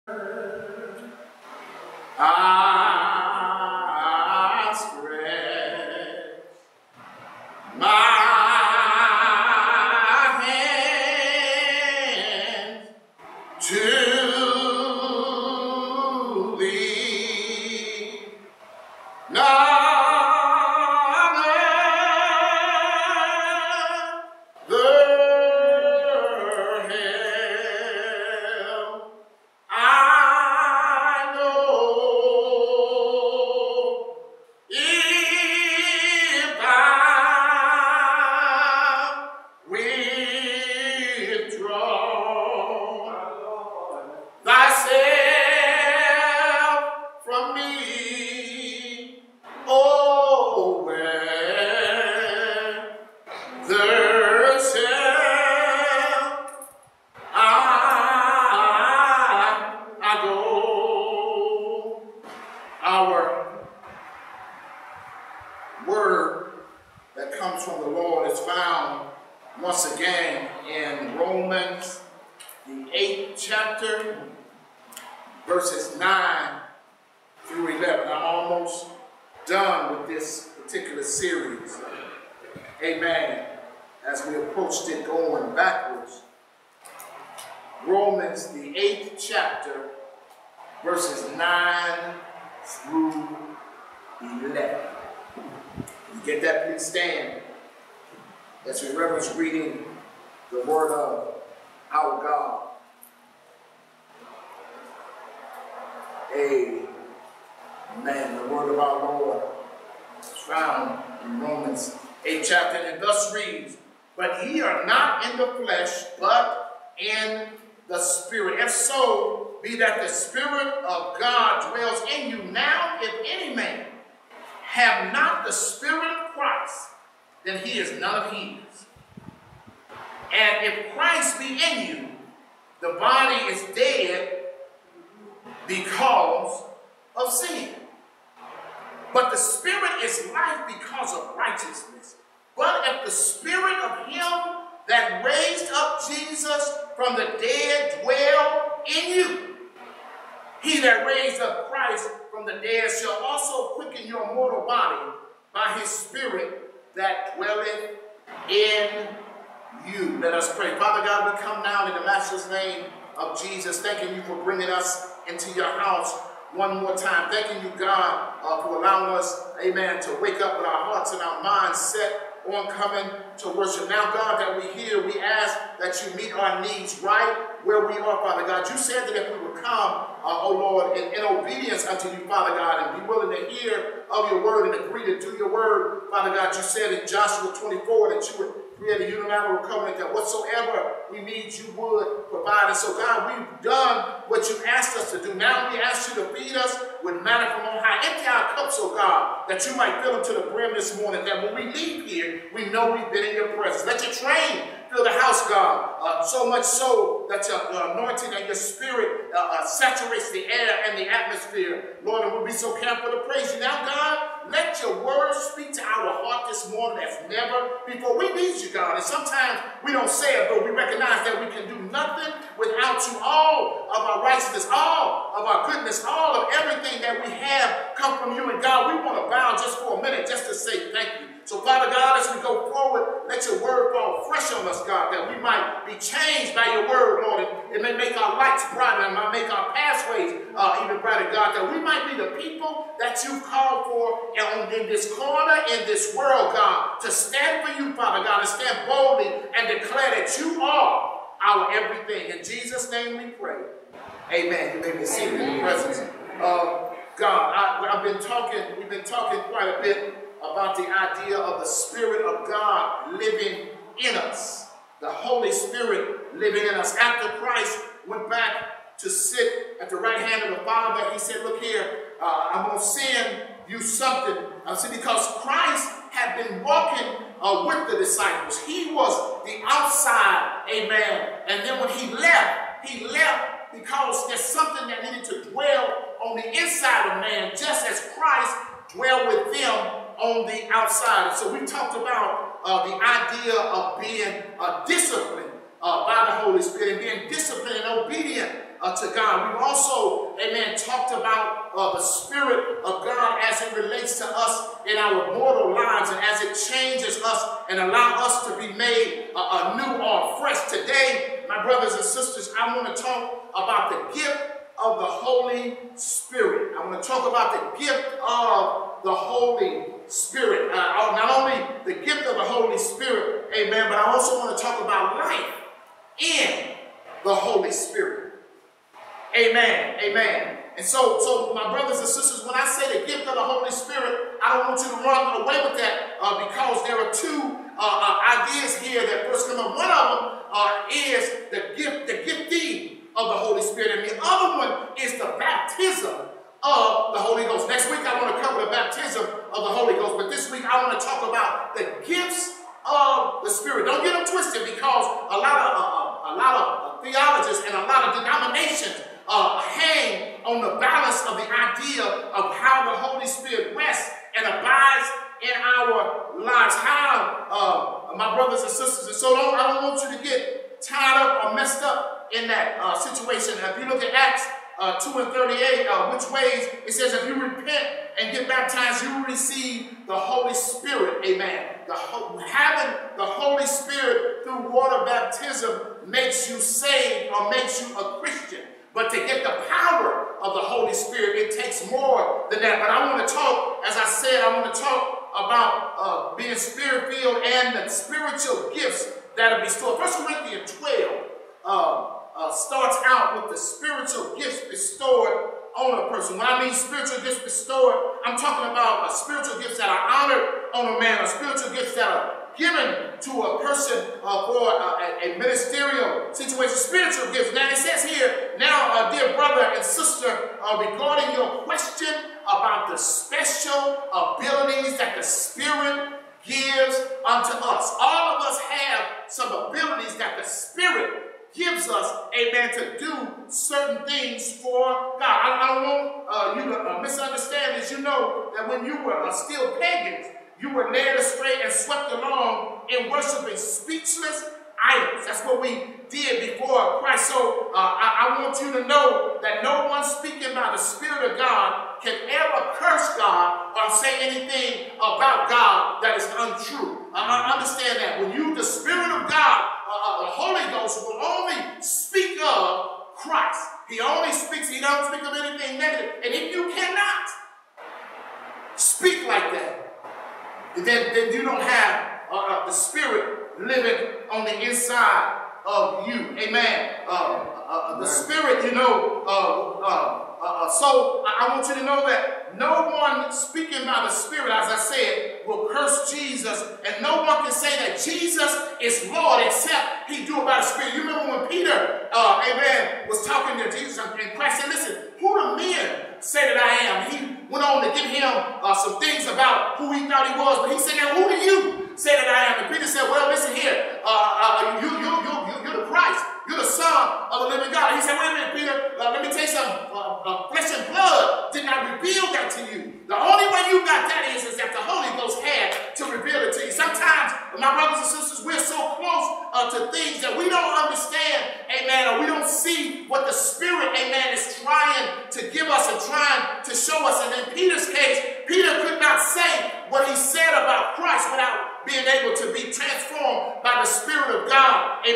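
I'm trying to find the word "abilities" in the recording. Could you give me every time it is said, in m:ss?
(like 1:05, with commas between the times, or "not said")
7:04, 7:09.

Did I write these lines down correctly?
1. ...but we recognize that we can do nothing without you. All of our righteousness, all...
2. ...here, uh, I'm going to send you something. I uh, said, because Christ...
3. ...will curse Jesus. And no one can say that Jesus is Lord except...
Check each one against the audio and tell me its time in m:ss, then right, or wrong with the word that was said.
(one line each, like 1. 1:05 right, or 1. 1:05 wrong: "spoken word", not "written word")
1. 3:40 right
2. 4:31 right
3. 8:05 right.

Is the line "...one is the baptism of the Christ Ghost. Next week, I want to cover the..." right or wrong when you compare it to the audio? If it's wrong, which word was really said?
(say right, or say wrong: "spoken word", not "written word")
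wrong: "Holy", not "Christ".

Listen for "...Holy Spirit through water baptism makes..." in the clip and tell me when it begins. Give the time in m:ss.
6:23.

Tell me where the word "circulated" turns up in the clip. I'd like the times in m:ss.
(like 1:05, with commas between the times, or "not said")
not said.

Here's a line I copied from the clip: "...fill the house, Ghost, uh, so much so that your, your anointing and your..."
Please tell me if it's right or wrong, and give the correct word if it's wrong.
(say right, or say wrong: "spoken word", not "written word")
wrong: "God", not "Ghost".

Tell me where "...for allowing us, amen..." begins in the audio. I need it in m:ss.
2:48.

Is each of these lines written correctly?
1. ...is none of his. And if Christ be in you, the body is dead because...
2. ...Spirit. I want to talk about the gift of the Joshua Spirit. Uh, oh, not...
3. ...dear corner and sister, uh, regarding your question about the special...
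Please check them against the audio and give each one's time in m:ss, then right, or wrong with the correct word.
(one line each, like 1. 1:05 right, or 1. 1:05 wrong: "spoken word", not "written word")
1. 2:07 right
2. 5:15 wrong: "Holy", not "Joshua"
3. 6:59 wrong: "brother", not "corner".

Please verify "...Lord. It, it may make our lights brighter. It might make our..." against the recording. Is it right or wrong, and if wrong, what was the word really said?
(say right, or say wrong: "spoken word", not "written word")
right.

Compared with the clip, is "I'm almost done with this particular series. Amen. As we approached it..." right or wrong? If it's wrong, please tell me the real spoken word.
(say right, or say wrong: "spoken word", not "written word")
right.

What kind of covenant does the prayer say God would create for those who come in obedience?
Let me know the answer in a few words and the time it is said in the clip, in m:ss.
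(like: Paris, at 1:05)
unilateral covenant, at 3:09.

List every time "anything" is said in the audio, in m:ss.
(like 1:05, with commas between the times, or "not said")
7:34, 7:45.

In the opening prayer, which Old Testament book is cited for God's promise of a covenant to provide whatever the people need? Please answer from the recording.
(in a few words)
Joshua 24.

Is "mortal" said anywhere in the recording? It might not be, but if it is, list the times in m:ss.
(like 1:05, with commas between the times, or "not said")
2:34, 5:05.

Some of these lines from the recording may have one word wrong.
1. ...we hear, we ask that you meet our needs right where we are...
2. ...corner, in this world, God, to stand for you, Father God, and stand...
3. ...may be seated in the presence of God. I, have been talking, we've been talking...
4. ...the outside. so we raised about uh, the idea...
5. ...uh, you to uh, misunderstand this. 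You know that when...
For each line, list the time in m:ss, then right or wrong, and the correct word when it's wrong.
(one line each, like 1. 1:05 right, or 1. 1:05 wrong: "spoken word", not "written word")
1. 2:54 right
2. 4:05 right
3. 4:14 right
4. 4:50 wrong: "talked", not "raised"
5. 7:16 right.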